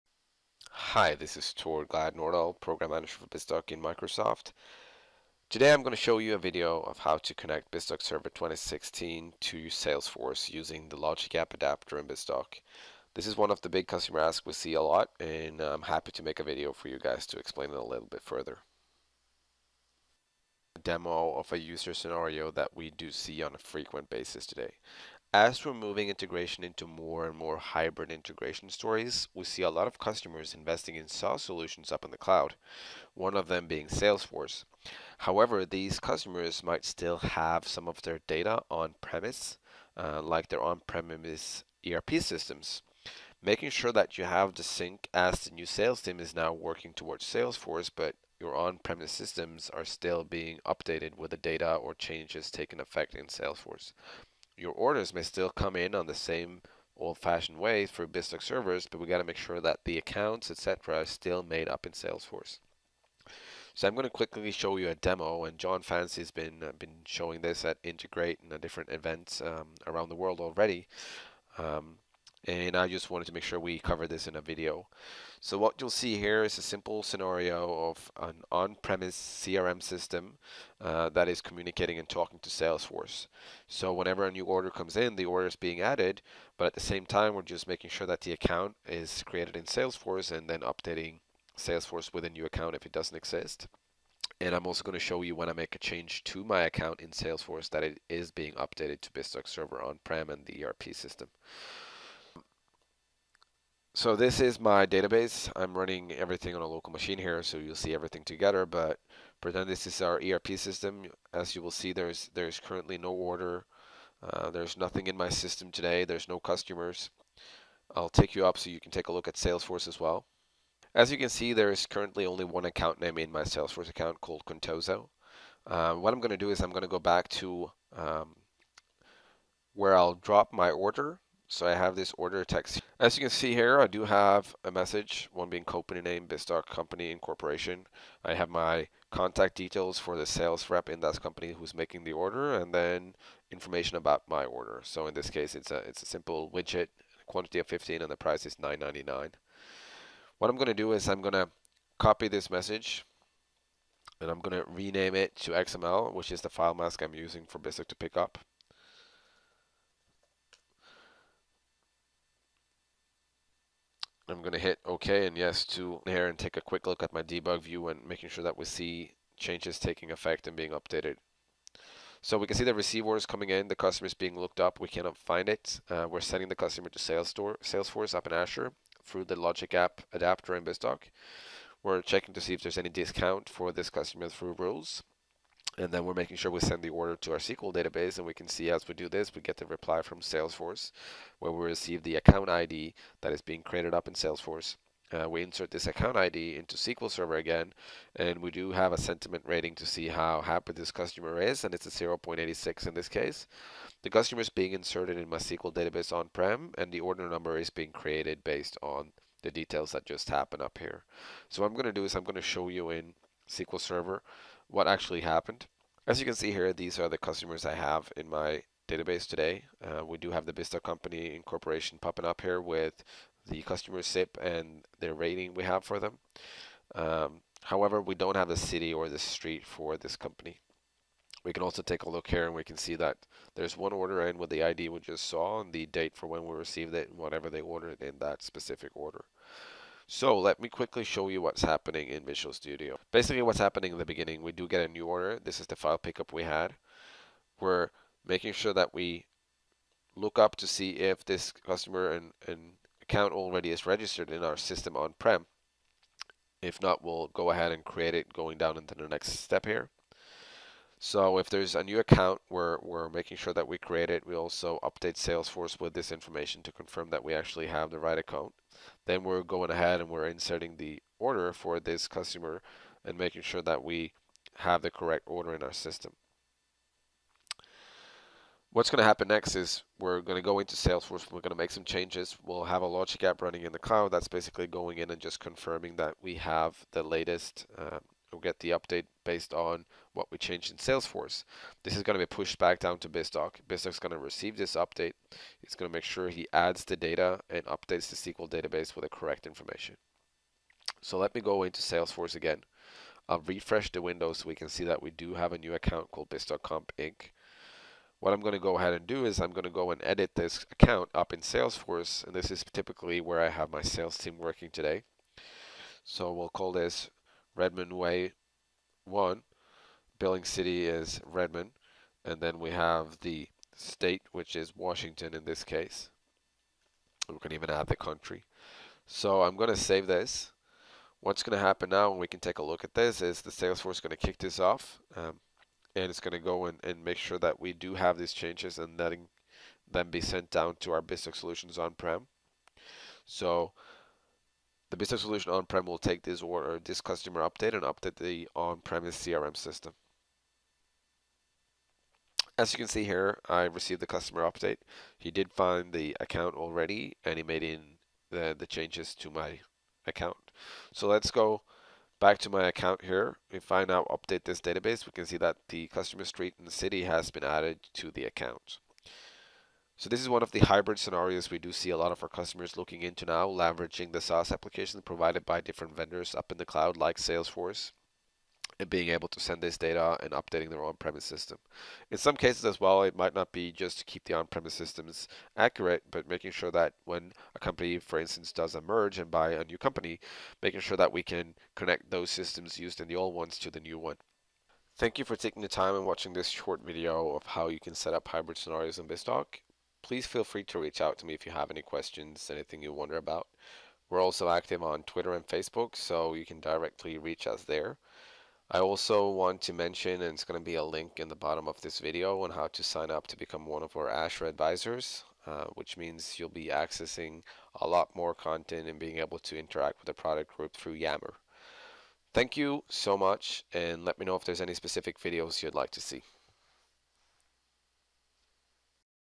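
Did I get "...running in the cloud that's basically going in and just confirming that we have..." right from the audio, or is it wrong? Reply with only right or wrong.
right.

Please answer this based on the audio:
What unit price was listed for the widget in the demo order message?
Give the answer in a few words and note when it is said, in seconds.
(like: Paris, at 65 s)
9.99, at 148 s.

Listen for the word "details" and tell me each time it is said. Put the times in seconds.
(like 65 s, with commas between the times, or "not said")
139 s, 209 s.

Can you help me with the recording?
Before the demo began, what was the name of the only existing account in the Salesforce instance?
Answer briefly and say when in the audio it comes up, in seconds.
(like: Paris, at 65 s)
Contoso, at 124 s.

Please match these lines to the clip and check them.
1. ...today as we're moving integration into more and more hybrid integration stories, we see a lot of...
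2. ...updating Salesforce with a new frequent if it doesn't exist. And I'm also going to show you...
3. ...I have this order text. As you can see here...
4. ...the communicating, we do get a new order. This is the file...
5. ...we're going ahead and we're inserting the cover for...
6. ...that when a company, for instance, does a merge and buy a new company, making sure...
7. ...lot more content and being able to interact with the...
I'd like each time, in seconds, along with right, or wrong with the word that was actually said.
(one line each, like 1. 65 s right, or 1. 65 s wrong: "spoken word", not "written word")
1. 24 s right
2. 90 s wrong: "account", not "frequent"
3. 131 s right
4. 243 s wrong: "beginning", not "communicating"
5. 269 s wrong: "order", not "cover"
6. 386 s right
7. 417 s right.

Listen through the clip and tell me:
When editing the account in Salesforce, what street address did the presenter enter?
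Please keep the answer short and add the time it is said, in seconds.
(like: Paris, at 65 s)
Redmond Way 1, at 317 s.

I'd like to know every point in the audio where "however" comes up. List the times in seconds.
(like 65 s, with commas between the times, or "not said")
35 s, 227 s.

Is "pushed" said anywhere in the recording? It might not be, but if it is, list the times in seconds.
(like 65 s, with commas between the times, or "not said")
292 s.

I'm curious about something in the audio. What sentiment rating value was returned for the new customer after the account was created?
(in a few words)
0.86.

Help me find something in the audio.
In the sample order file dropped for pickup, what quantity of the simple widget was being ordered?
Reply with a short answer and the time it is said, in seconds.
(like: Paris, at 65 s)
15, at 147 s.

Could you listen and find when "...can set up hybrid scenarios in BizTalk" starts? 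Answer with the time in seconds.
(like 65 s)
397 s.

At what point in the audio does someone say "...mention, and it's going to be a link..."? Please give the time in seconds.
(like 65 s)
409 s.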